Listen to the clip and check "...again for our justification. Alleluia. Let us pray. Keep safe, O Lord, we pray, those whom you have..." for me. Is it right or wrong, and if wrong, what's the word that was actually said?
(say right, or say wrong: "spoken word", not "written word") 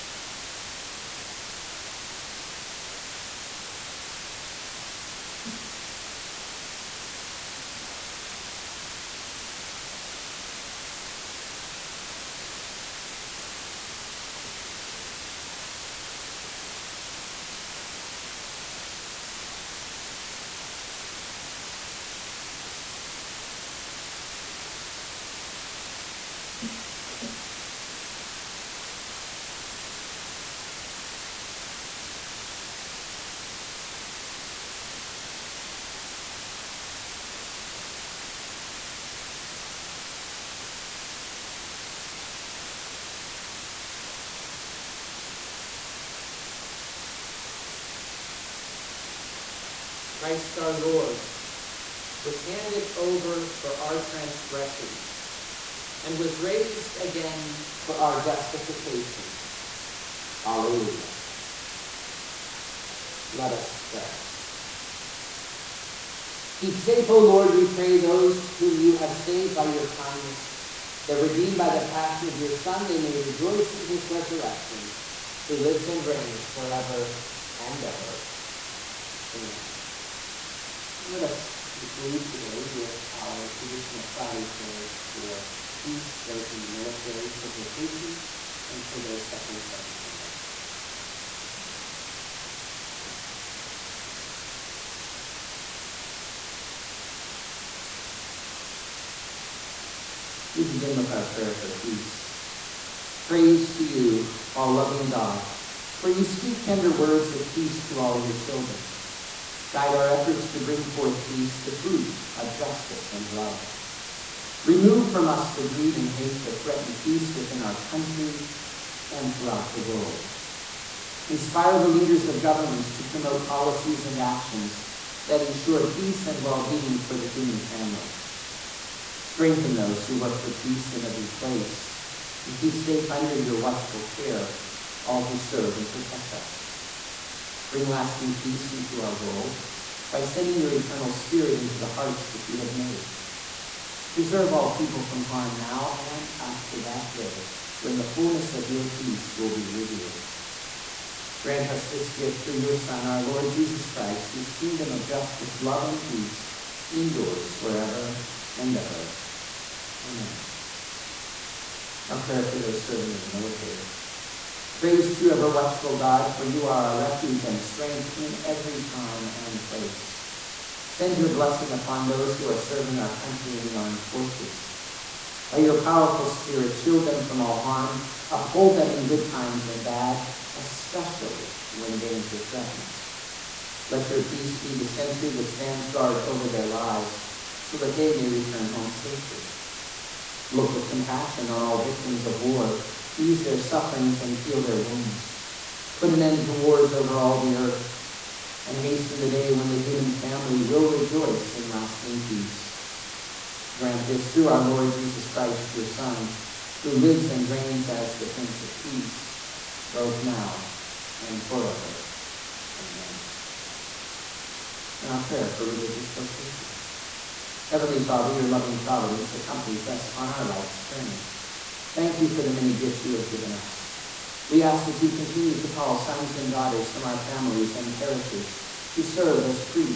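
right.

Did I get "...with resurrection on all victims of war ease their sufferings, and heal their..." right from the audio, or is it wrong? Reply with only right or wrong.
wrong.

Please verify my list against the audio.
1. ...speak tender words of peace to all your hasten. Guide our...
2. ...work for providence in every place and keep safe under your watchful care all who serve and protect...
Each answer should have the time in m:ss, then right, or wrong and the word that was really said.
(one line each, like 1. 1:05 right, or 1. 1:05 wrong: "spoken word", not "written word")
1. 1:46 wrong: "children", not "hasten"
2. 2:10 wrong: "peace", not "providence".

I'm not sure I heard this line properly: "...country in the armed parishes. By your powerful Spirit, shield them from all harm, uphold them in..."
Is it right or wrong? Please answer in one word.
wrong.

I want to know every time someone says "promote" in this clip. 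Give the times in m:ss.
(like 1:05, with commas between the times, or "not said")
2:03.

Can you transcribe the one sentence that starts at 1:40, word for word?
We begin with our prayer for peace.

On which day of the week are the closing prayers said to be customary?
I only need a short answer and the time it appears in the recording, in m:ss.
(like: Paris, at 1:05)
Friday, at 1:24.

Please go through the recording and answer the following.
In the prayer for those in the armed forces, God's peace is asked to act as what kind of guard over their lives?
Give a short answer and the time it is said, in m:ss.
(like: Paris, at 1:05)
the sentry, at 3:04.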